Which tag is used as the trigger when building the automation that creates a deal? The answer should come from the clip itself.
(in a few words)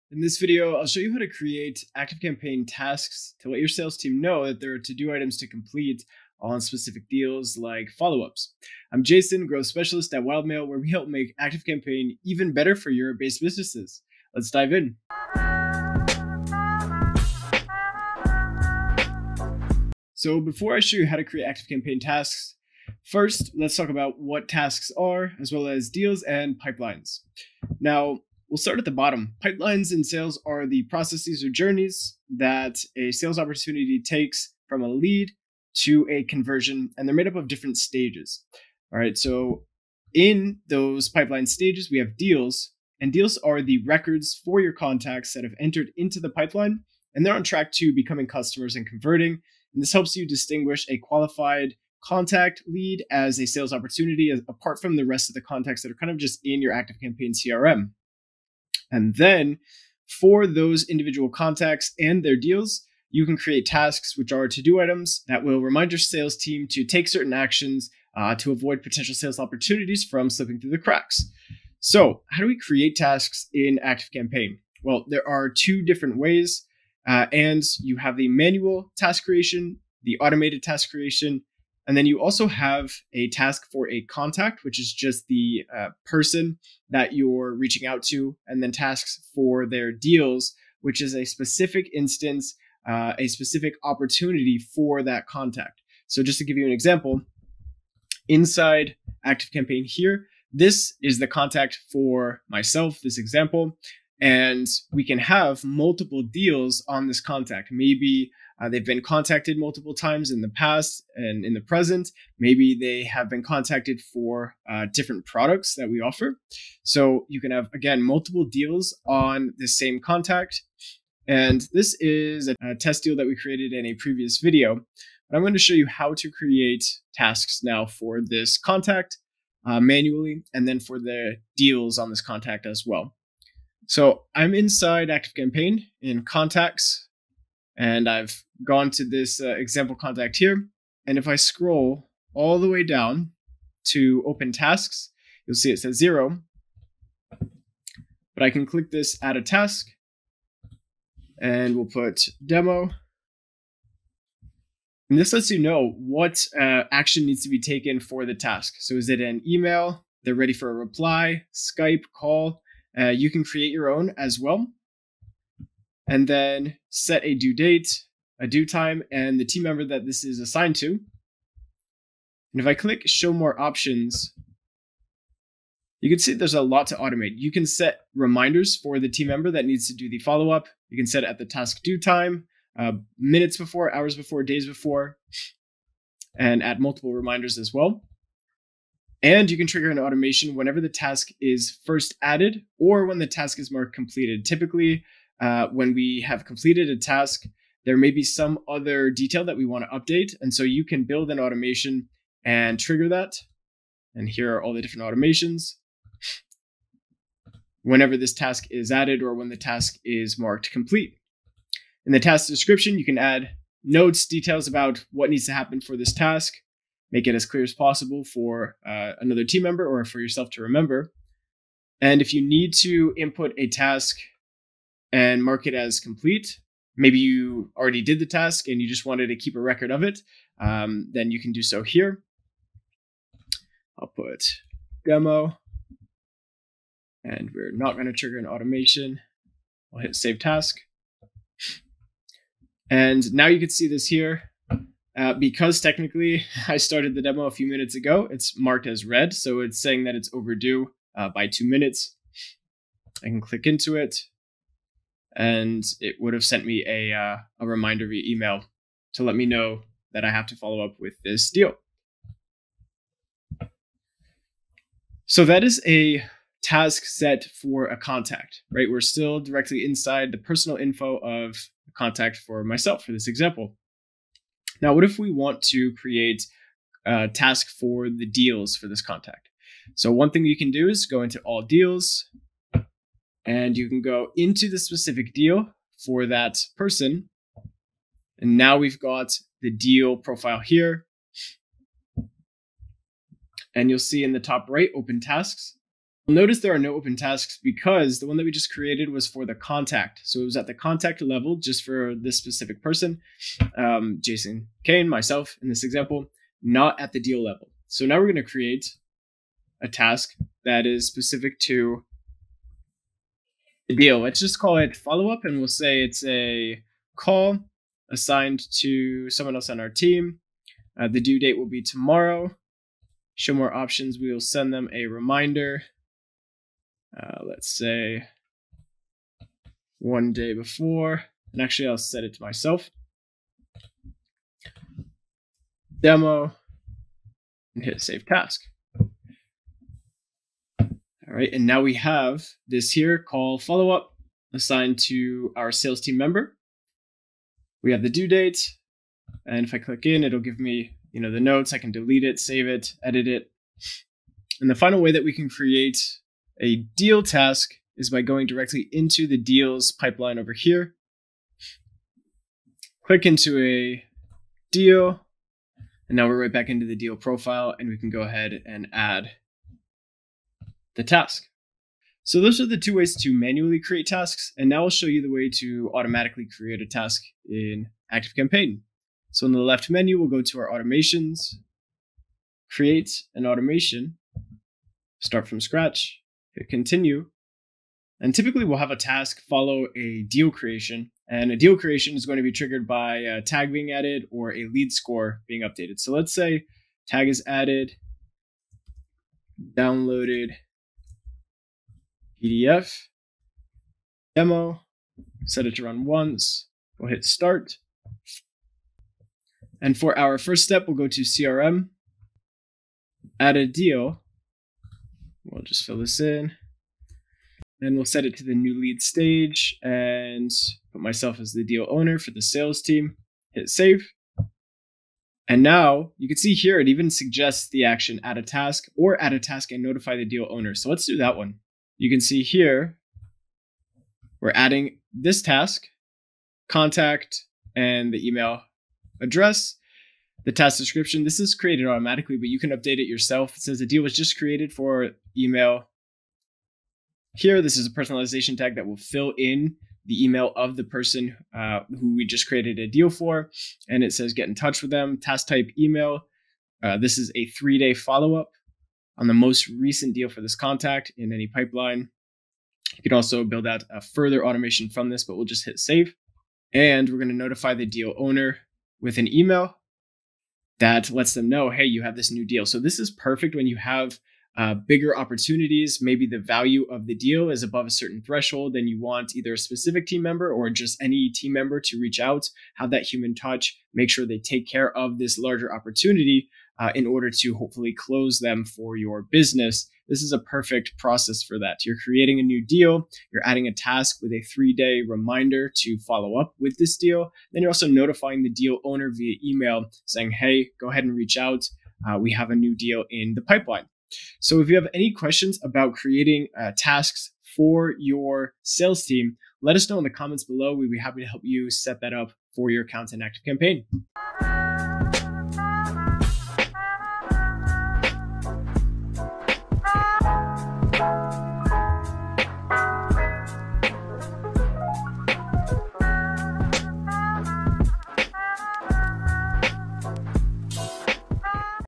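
downloaded PDF.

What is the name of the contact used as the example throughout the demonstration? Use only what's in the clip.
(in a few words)
Jason Kane.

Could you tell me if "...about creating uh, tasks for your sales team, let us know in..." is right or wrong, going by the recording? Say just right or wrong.
right.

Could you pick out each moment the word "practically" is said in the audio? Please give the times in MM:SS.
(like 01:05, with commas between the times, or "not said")
not said.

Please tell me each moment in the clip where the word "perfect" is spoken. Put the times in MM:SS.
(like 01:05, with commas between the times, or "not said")
07:53, 08:10.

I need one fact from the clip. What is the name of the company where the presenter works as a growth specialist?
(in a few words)
Wildmail.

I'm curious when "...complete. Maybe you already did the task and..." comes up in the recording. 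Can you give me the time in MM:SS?
03:45.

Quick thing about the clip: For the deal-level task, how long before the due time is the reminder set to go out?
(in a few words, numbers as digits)
one day.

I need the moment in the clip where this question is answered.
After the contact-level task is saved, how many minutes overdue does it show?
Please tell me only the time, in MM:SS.
04:11.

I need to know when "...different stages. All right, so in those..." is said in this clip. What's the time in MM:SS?
00:37.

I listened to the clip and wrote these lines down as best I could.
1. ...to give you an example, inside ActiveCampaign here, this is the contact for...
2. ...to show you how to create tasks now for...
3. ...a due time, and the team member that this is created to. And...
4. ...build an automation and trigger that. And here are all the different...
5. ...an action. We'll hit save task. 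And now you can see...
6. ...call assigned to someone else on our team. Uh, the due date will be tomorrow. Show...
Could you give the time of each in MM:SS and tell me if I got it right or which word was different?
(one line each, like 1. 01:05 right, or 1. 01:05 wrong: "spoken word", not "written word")
1. 01:36 right
2. 02:05 right
3. 02:48 wrong: "assigned", not "created"
4. 03:21 right
5. 03:58 wrong: "automation", not "action"
6. 05:17 right.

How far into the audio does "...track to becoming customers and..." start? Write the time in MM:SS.
00:47.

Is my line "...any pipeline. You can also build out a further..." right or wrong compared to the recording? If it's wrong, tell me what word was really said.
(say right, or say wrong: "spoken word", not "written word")
right.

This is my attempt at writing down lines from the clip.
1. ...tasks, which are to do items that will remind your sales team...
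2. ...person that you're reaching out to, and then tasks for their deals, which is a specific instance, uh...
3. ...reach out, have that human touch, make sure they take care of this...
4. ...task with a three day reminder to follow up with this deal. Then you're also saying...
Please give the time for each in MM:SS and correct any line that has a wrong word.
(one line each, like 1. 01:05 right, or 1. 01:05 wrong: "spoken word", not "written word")
1. 01:03 right
2. 01:26 right
3. 08:02 right
4. 08:13 wrong: "notifying", not "saying".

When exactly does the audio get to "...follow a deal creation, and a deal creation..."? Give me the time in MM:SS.
06:29.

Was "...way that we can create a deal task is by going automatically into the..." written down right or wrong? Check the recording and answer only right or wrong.
wrong.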